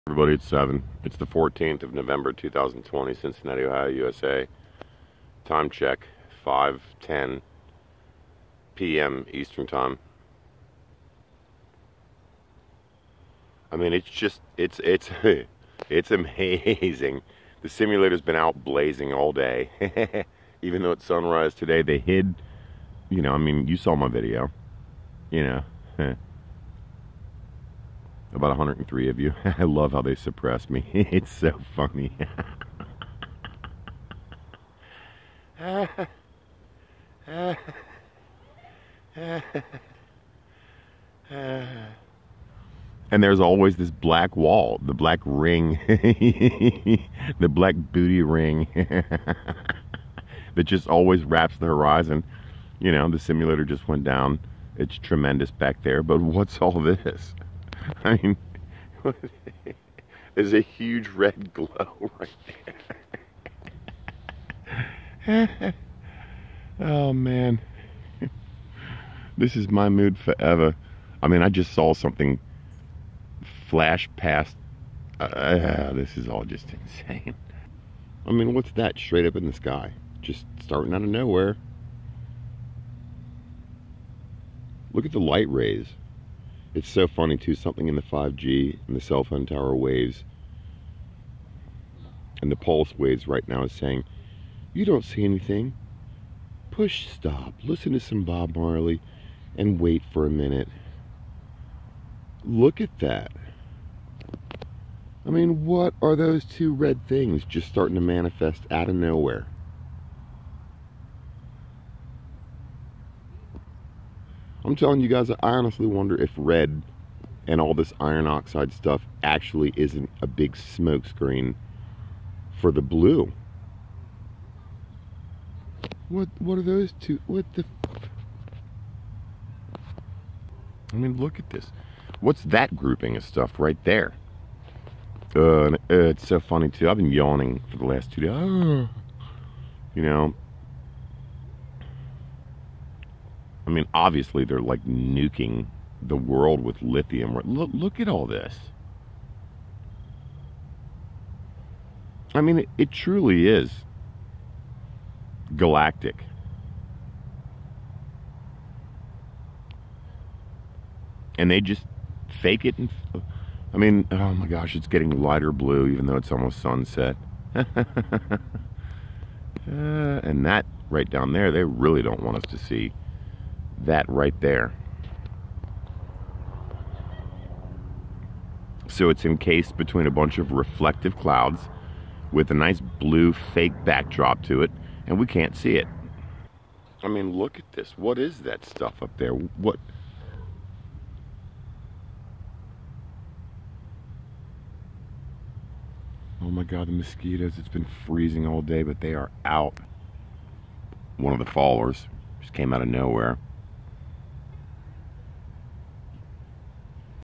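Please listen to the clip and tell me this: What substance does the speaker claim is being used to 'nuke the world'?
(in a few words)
lithium.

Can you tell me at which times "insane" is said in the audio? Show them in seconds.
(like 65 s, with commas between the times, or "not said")
76 s.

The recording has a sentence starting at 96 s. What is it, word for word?
Push stop, listen to some Bob Marley and wait for a minute.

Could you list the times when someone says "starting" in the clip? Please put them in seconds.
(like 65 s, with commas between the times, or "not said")
80 s, 107 s.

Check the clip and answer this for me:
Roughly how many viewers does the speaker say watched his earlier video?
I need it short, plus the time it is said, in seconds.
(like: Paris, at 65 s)
103, at 28 s.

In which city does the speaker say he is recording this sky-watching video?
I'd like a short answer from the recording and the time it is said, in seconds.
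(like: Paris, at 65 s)
Cincinnati, at 3 s.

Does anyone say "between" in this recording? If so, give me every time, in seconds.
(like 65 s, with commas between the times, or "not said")
179 s.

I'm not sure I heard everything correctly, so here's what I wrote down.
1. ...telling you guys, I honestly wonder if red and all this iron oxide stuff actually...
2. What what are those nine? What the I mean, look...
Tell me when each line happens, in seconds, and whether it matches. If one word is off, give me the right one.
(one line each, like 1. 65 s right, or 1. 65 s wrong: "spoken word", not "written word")
1. 114 s right
2. 126 s wrong: "two", not "nine".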